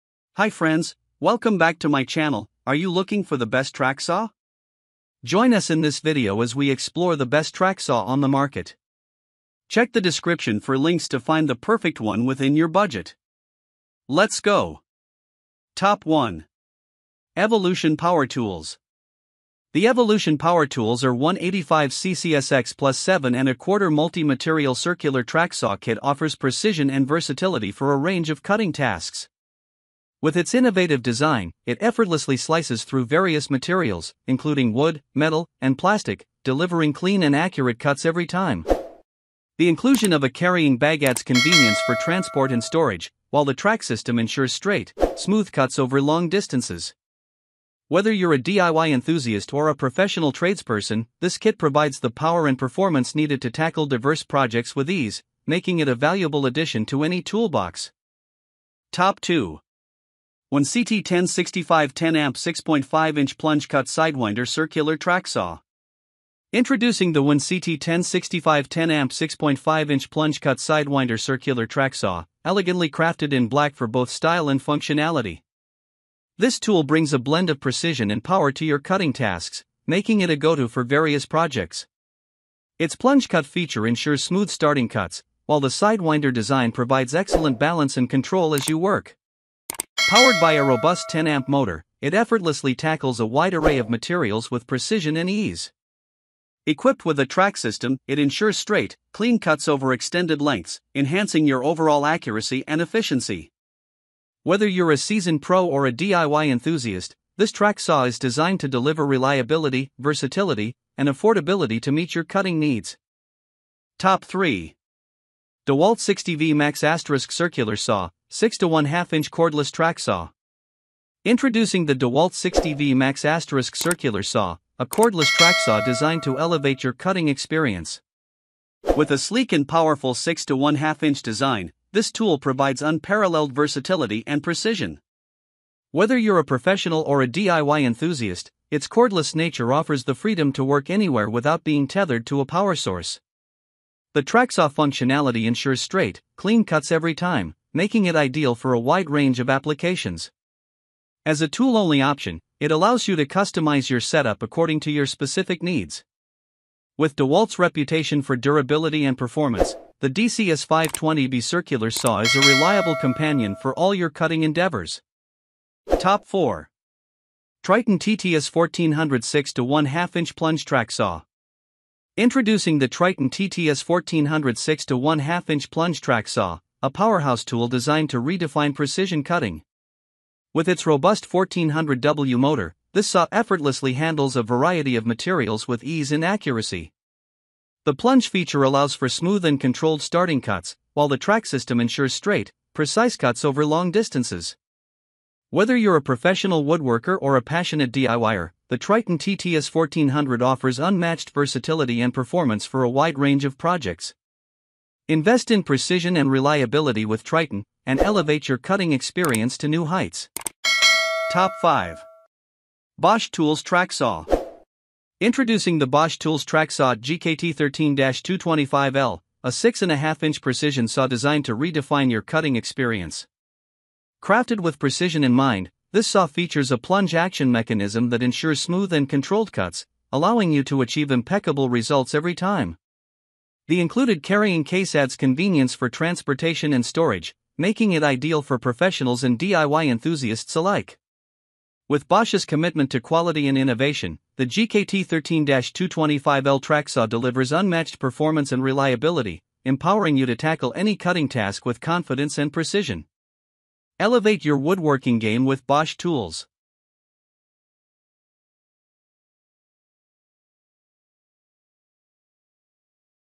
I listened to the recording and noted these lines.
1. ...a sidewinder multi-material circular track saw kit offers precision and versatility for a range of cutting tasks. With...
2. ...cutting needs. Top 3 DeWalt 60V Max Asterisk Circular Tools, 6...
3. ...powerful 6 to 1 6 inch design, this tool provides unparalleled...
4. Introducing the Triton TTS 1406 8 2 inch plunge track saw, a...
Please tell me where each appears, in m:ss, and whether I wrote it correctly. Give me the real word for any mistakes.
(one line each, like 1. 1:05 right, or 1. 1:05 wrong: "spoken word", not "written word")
1. 0:23 wrong: "quarter", not "sidewinder"
2. 1:52 wrong: "Saw", not "Tools"
3. 2:09 wrong: "2", not "6"
4. 2:52 wrong: "1", not "8".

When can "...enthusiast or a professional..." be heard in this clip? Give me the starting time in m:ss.
0:48.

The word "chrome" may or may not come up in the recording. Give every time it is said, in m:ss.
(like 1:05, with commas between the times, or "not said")
not said.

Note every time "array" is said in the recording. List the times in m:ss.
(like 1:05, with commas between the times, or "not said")
1:33.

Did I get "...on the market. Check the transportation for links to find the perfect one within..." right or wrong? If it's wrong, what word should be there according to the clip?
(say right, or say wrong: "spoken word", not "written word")
wrong: "description", not "transportation".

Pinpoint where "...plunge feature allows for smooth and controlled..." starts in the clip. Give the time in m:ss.
3:07.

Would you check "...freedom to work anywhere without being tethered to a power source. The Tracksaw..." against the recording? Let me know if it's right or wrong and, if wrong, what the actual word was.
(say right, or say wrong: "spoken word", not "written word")
right.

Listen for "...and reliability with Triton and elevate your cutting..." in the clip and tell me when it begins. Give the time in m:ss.
3:26.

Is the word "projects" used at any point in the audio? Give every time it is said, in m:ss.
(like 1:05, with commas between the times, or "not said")
0:54, 1:21, 3:23.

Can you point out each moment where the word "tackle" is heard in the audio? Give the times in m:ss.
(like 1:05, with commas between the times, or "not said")
0:53, 1:32, 4:10.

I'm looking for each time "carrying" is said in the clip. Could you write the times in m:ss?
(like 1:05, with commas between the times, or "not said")
0:40, 3:54.